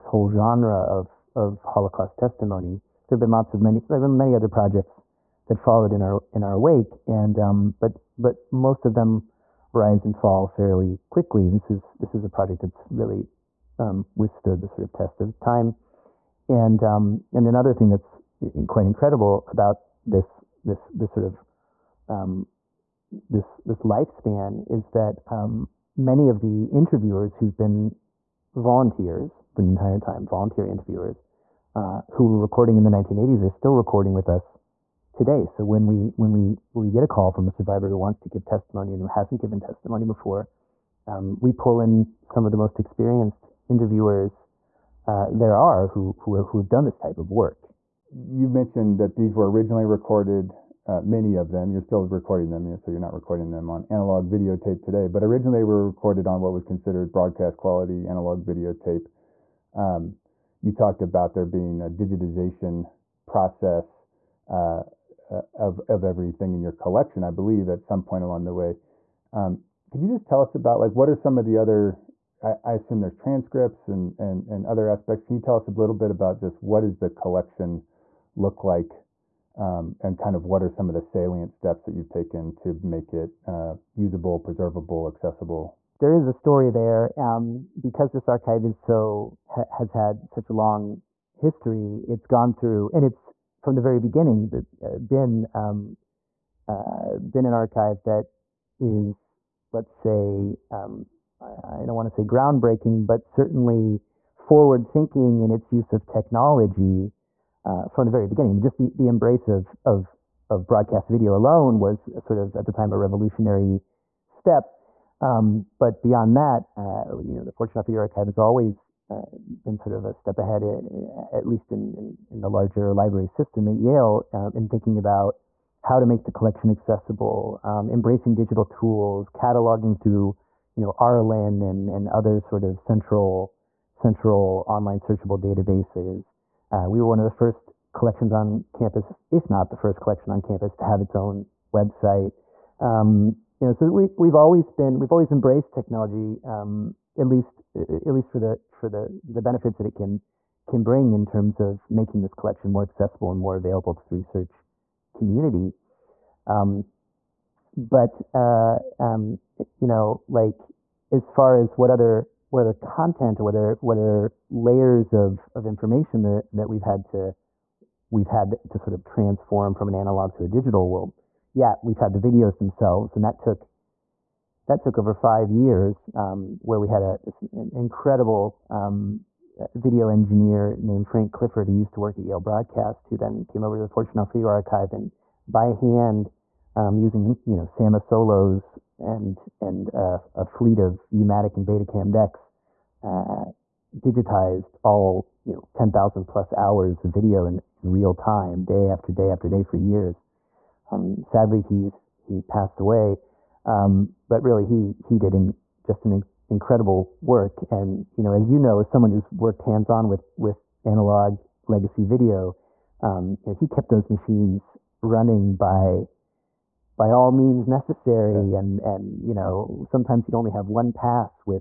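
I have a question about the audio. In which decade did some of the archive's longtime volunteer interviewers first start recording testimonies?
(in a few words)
1980s.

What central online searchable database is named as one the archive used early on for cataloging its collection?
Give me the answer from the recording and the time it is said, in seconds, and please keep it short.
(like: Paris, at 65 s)
RLIN, at 130 s.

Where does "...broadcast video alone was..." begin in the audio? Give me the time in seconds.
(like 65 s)
110 s.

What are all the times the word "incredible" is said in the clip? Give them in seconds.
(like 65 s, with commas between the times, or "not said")
18 s, 177 s, 206 s.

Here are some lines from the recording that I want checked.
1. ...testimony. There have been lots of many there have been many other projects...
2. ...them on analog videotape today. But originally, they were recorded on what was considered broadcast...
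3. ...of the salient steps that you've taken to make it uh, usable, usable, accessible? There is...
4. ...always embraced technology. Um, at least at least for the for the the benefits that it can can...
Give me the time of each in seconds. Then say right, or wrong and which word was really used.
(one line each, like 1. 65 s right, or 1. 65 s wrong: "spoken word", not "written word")
1. 2 s right
2. 53 s right
3. 80 s wrong: "preservable", not "usable"
4. 145 s right.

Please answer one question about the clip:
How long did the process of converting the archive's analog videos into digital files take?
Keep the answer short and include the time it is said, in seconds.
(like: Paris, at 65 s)
Over 5 years, at 174 s.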